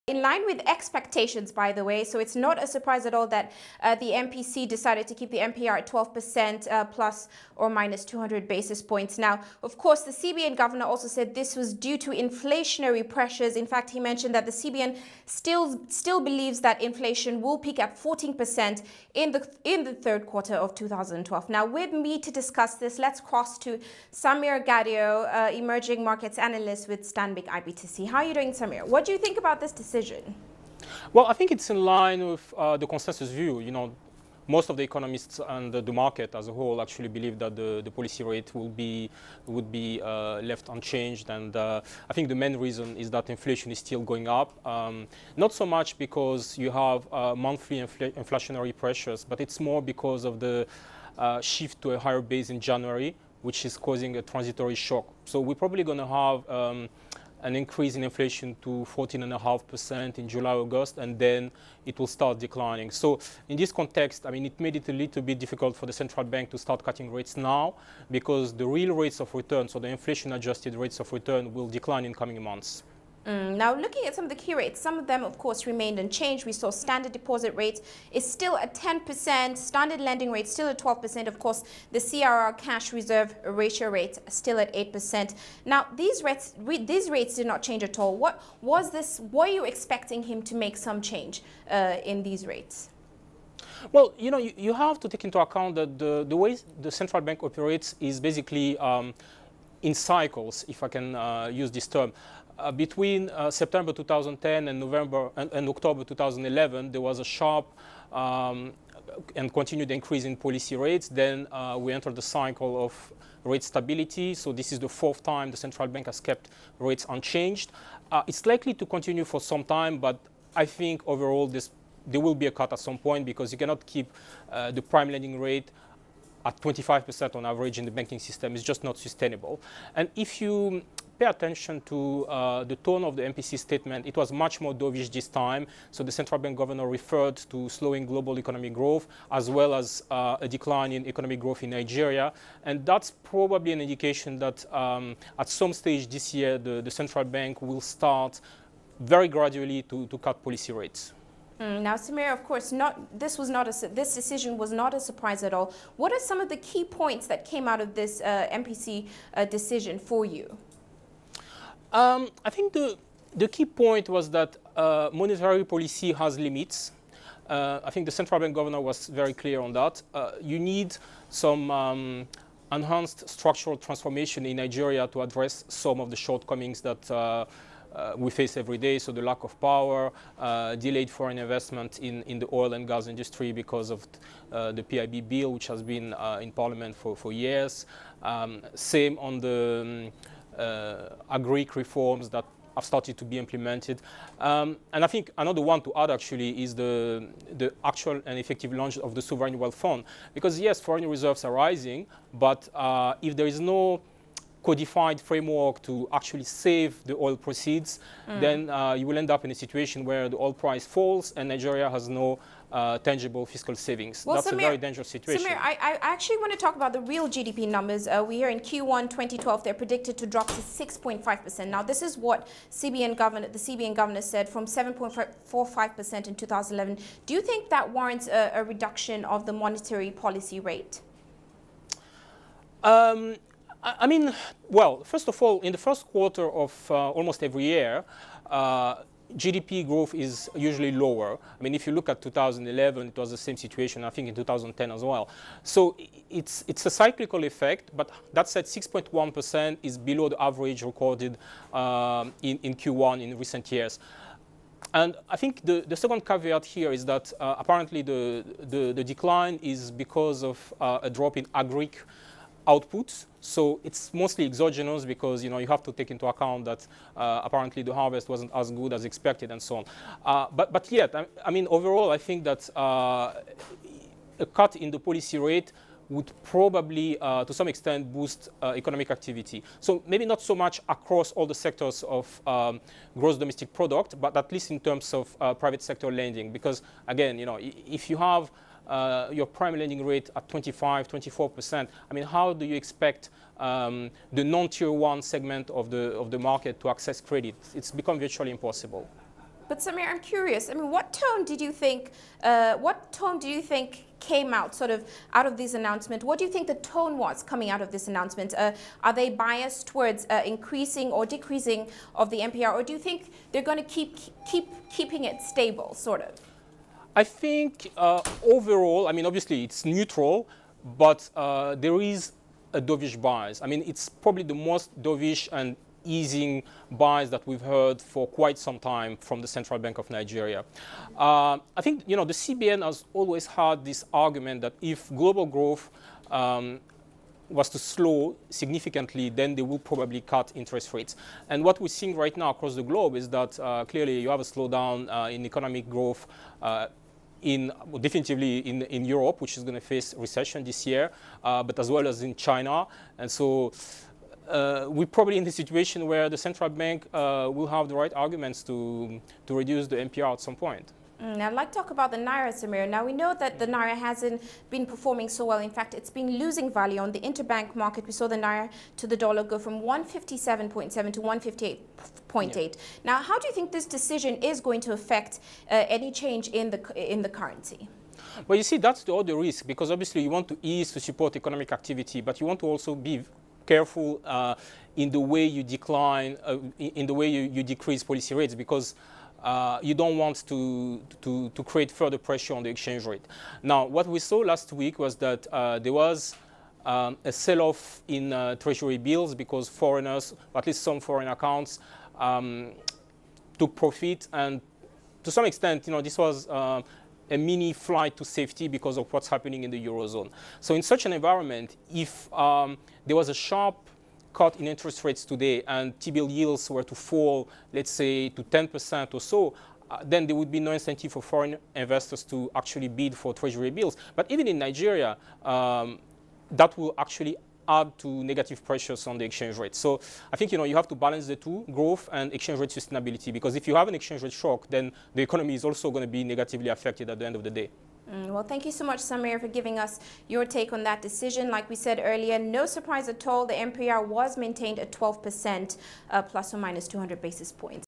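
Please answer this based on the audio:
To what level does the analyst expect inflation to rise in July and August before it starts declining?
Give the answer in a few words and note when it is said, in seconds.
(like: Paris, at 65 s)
14.5%, at 58 s.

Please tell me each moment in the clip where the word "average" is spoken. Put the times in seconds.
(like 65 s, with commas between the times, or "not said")
127 s, 250 s.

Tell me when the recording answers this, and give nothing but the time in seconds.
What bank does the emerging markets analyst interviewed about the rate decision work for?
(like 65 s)
27 s.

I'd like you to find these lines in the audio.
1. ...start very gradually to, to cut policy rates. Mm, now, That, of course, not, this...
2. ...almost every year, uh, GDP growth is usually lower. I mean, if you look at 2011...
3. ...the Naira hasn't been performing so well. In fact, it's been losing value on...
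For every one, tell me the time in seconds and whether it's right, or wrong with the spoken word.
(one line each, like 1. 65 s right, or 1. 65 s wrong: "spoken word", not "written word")
1. 147 s wrong: "Samira", not "That"
2. 237 s right
3. 363 s right.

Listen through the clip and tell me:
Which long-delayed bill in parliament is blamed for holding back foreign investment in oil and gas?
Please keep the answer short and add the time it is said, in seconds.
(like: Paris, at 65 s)
PIB, at 184 s.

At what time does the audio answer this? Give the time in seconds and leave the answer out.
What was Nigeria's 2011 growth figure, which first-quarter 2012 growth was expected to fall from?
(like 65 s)
224 s.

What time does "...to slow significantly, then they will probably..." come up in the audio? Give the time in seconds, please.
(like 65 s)
337 s.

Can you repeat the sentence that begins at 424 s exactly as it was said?
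But even in Nigeria, um, that will actually add to negative pressures on the exchange rate.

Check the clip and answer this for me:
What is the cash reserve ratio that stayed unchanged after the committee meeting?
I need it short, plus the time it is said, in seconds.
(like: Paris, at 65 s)
8%, at 84 s.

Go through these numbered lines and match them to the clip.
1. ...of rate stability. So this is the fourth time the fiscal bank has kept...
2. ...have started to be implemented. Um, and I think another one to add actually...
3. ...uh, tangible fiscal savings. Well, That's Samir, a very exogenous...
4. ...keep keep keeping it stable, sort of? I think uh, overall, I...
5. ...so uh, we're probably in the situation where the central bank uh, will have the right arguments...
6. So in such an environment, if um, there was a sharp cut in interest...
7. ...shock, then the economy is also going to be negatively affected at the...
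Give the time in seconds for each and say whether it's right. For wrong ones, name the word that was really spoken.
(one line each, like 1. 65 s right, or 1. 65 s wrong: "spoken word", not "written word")
1. 112 s wrong: "central", not "fiscal"
2. 192 s right
3. 212 s wrong: "dangerous", not "exogenous"
4. 313 s right
5. 353 s right
6. 410 s right
7. 434 s right.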